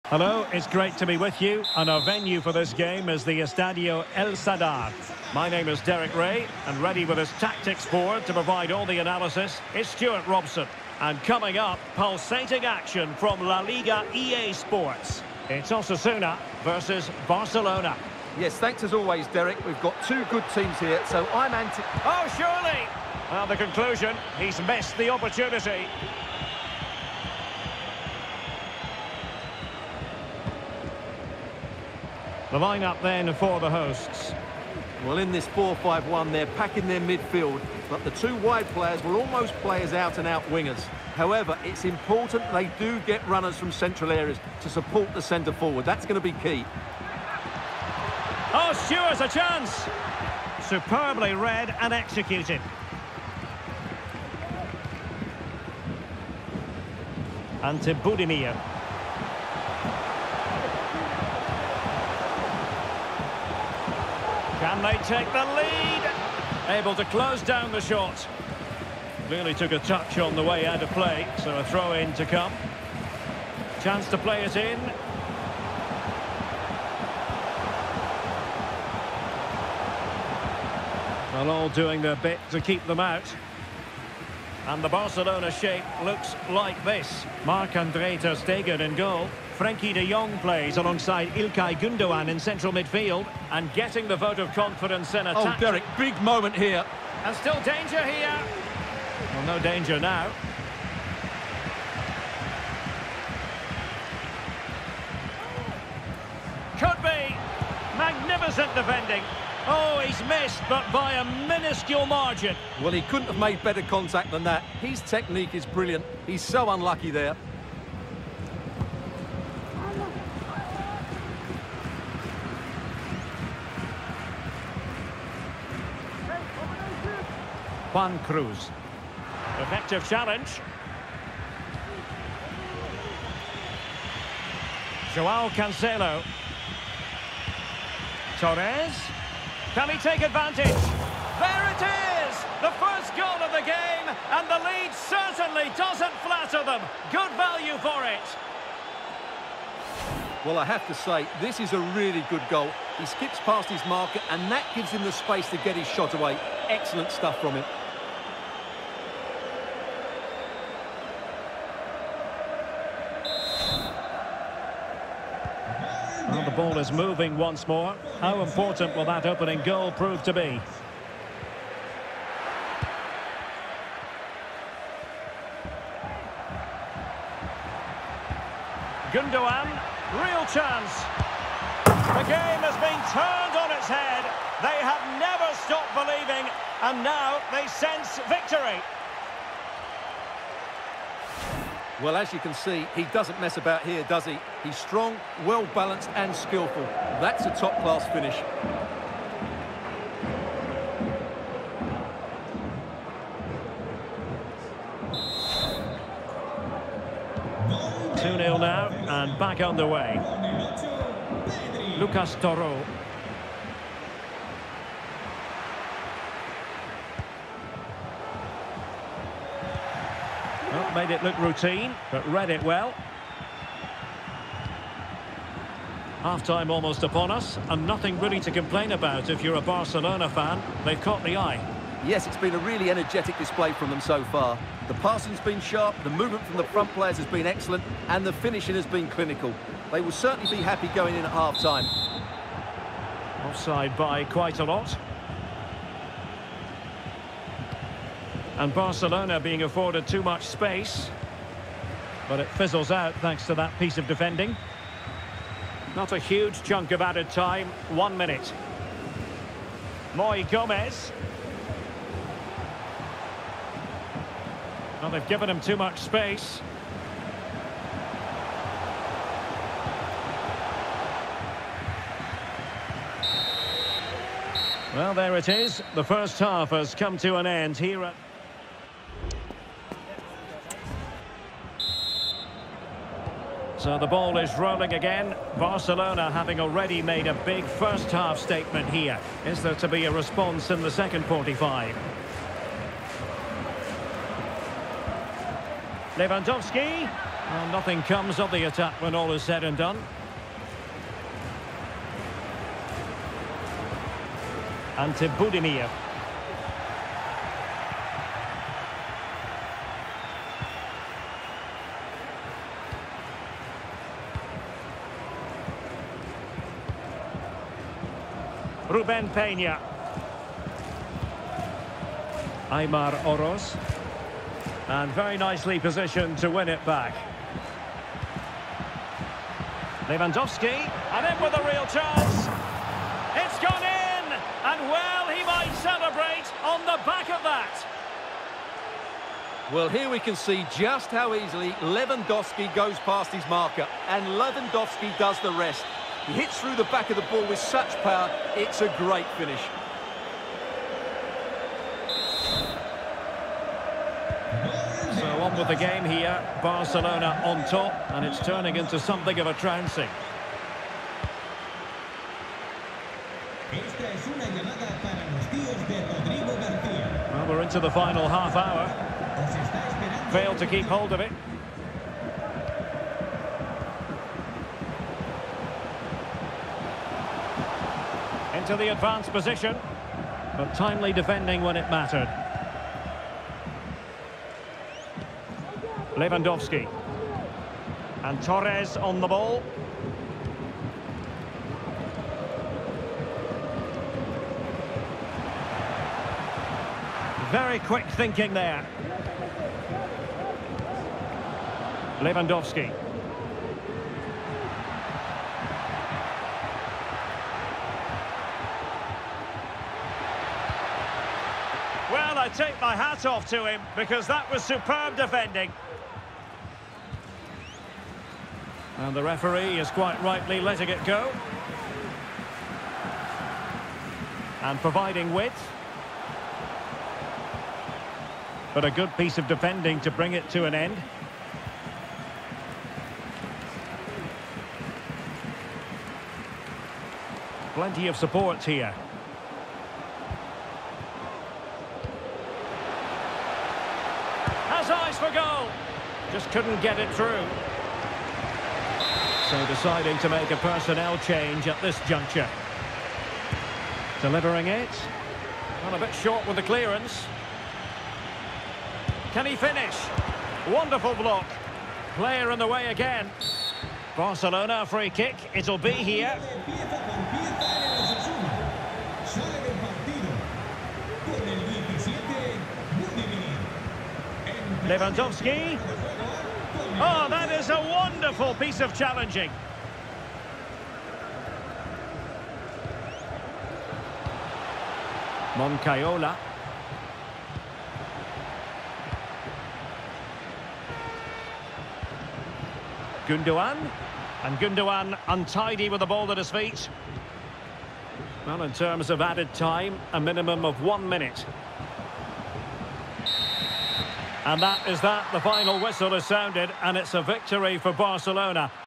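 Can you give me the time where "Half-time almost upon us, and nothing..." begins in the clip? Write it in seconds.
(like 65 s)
226 s.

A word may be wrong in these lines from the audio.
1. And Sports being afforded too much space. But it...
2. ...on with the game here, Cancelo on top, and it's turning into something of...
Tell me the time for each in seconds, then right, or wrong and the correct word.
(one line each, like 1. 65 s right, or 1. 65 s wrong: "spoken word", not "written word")
1. 248 s wrong: "Barcelona", not "Sports"
2. 355 s wrong: "Barcelona", not "Cancelo".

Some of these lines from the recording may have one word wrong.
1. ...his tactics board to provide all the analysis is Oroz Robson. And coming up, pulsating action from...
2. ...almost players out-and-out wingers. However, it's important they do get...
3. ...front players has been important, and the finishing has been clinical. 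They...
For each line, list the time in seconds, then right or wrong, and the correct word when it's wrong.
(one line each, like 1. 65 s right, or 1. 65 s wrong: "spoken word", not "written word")
1. 7 s wrong: "Stuart", not "Oroz"
2. 39 s right
3. 236 s wrong: "excellent", not "important".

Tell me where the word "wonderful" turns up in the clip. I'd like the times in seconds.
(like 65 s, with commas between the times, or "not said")
460 s, 477 s.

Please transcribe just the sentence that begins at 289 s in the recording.
Is there to be a response in the second 45?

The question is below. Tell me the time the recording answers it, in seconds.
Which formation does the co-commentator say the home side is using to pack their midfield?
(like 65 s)
35 s.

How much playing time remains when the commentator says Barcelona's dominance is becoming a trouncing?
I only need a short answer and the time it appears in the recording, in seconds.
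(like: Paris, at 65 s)
final half hour, at 367 s.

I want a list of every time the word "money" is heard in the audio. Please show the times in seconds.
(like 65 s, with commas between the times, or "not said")
not said.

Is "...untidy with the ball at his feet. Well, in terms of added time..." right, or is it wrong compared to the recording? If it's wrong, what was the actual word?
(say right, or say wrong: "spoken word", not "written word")
right.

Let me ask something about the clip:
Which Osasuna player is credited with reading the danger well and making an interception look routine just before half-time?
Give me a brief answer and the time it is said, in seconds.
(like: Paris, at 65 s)
Lucas Torró, at 211 s.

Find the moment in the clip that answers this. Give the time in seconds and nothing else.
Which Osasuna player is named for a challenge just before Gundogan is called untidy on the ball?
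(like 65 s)
485 s.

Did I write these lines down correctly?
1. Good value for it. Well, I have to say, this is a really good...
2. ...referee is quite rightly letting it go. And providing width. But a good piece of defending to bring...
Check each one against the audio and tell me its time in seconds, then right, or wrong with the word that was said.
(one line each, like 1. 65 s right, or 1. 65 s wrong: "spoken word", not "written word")
1. 147 s right
2. 419 s right.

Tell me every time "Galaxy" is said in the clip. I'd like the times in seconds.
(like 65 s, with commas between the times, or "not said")
not said.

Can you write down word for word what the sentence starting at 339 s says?
Well, here we can see just how easily Lewandowski goes past his marker, and Lewandowski does the rest.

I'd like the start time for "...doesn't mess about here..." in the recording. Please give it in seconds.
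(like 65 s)
193 s.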